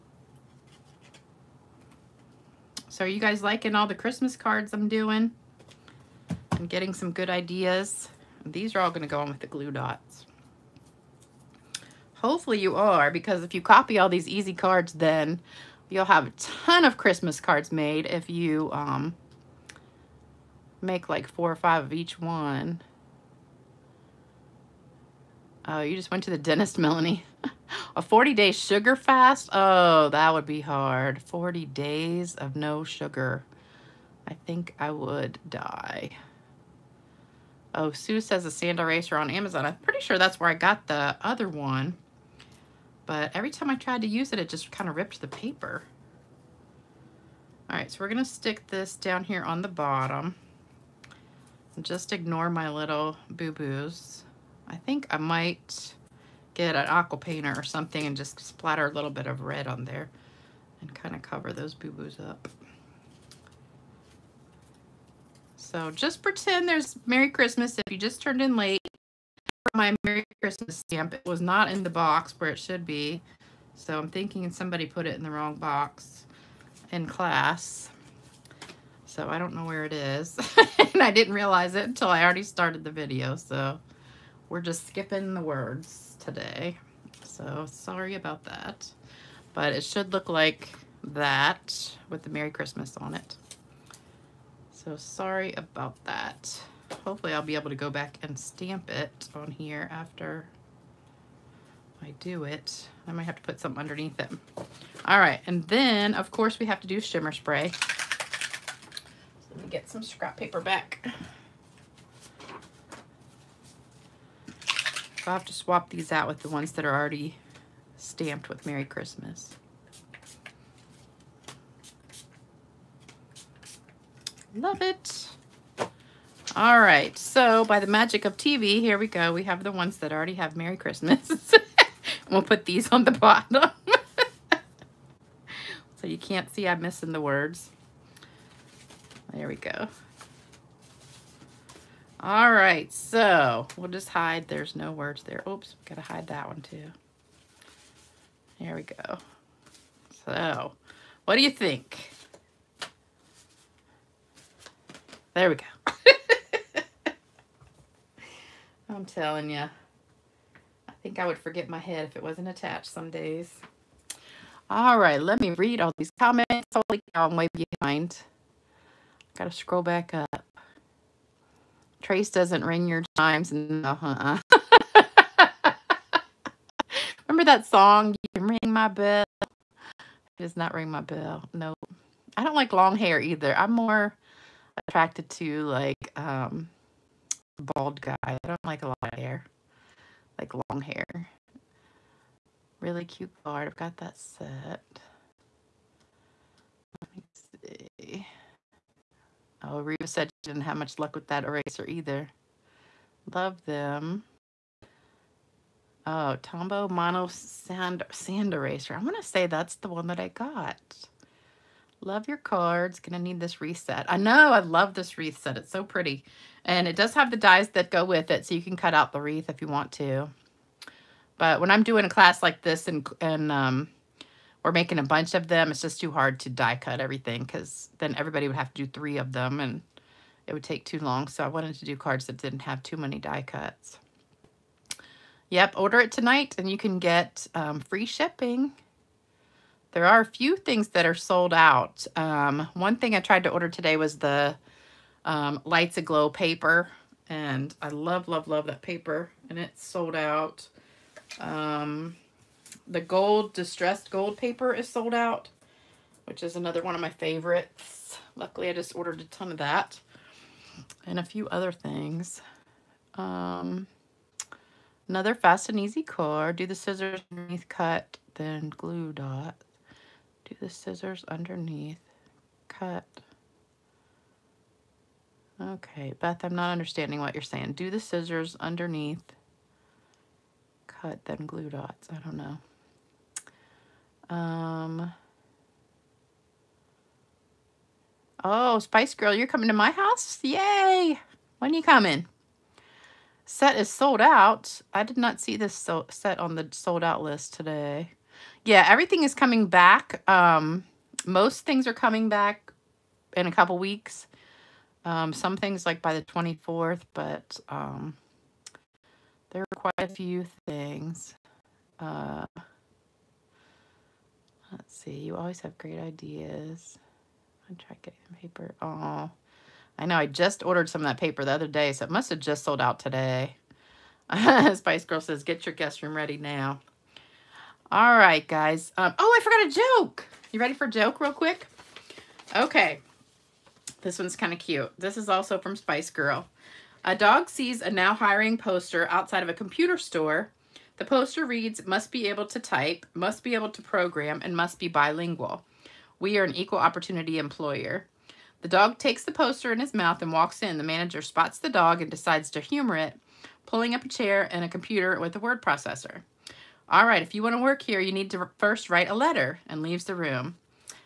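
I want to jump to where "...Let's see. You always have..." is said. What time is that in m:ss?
5:14.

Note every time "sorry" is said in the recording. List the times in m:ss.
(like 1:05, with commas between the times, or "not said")
1:27, 1:34.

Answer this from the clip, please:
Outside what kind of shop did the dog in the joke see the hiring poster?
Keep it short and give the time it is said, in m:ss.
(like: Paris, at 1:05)
computer store, at 5:39.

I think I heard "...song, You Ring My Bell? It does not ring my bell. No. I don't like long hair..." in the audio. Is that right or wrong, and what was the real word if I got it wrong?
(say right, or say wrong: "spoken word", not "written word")
right.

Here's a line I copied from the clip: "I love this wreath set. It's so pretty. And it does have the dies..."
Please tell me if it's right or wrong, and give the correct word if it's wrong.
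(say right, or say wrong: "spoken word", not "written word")
right.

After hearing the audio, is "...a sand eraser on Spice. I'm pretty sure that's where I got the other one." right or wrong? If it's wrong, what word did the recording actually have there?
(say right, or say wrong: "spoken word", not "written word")
wrong: "Amazon", not "Spice".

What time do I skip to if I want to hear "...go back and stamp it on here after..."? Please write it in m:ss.
1:37.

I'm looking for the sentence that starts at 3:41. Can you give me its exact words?
But when I'm doing a class like this and, and um, or making a bunch of them.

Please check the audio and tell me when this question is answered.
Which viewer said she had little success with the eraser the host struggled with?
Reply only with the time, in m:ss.
3:19.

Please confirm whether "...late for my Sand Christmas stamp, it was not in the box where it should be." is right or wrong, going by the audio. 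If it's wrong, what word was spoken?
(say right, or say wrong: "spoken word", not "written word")
wrong: "Merry", not "Sand".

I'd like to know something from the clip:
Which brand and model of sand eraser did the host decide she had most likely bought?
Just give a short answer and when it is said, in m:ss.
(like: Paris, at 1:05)
Tombow Mono Sand, at 3:26.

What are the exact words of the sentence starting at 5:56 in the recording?
All right, if you want to work here, you need to first write a letter and leaves the room.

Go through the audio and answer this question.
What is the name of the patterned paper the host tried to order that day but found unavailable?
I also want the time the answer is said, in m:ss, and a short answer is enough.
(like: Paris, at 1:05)
Lights Aglow, at 4:05.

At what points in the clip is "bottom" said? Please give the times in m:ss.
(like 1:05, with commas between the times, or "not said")
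0:49, 2:13.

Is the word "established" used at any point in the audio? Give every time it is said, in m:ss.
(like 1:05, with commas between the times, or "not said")
not said.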